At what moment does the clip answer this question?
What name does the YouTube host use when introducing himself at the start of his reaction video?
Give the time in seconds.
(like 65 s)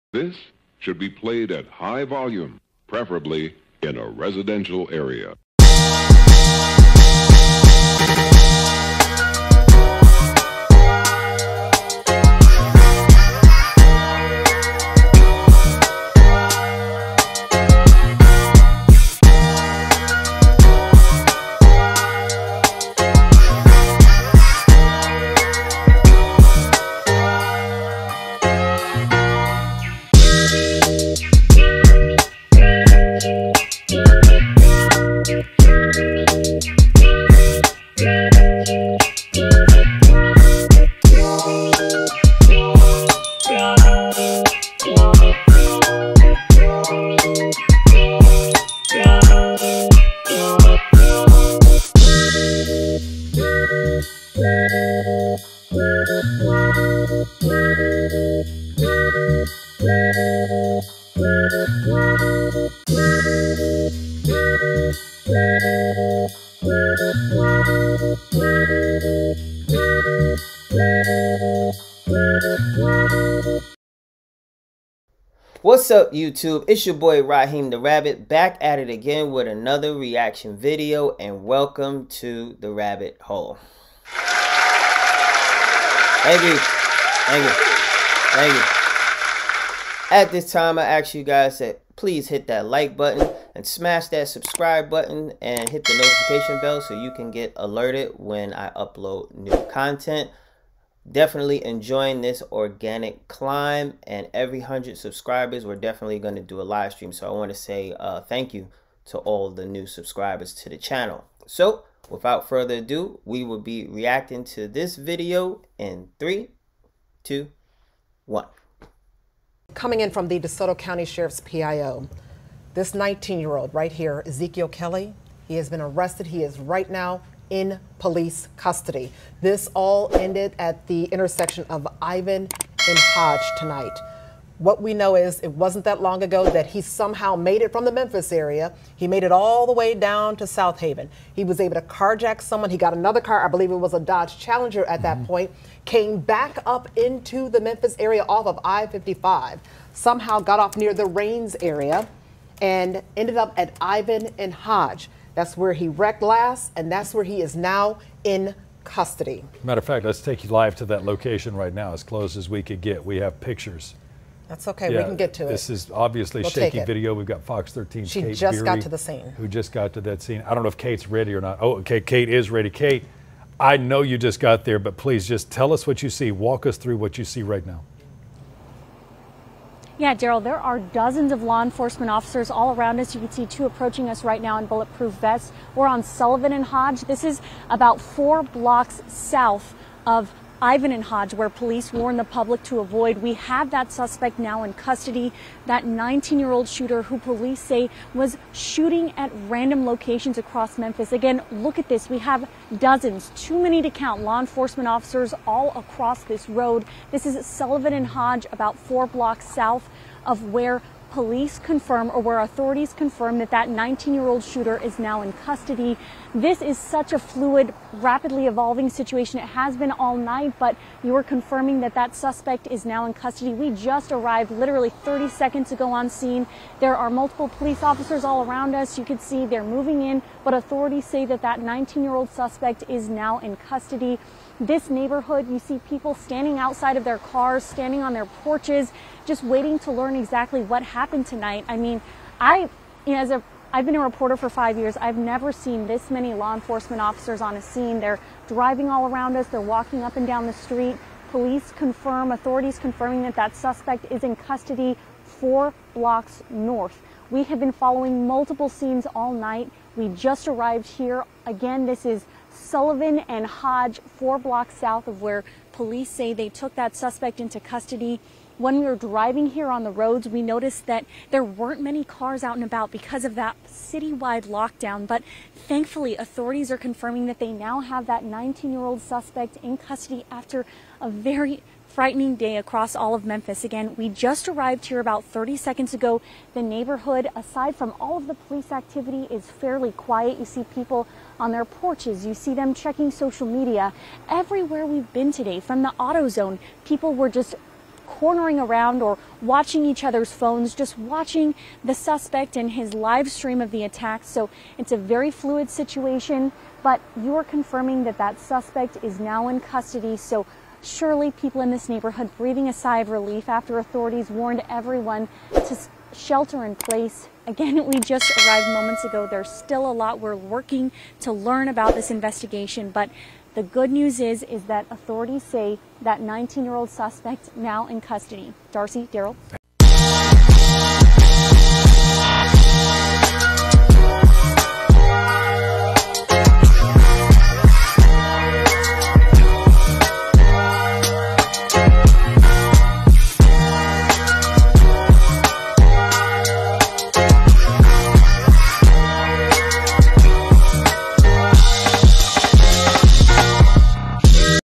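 77 s.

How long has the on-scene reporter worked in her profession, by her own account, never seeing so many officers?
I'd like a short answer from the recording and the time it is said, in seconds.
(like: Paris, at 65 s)
5 years, at 244 s.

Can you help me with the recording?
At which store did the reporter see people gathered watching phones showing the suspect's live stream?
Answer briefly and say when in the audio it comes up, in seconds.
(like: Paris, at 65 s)
AutoZone, at 295 s.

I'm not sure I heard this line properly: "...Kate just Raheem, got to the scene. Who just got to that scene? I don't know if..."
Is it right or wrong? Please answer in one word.
wrong.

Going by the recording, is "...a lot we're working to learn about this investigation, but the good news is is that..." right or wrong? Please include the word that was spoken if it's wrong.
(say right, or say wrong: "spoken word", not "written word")
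right.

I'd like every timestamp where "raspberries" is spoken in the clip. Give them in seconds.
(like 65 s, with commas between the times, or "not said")
not said.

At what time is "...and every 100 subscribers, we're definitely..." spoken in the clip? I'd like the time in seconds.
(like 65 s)
104 s.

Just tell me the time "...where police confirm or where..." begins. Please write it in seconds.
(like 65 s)
210 s.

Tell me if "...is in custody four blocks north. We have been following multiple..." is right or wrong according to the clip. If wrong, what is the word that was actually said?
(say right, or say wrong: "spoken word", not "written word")
right.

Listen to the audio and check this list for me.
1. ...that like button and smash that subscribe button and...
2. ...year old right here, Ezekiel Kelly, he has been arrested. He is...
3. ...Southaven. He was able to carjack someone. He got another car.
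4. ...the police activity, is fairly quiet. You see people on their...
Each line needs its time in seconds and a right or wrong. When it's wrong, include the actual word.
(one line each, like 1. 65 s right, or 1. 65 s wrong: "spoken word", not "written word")
1. 92 s right
2. 123 s right
3. 140 s right
4. 288 s right.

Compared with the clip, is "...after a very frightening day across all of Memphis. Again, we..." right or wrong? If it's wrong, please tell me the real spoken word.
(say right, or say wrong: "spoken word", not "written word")
right.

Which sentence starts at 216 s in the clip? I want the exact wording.
This is such a fluid, rapidly evolving situation.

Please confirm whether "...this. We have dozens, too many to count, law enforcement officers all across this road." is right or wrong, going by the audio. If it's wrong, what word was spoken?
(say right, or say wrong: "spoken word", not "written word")
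right.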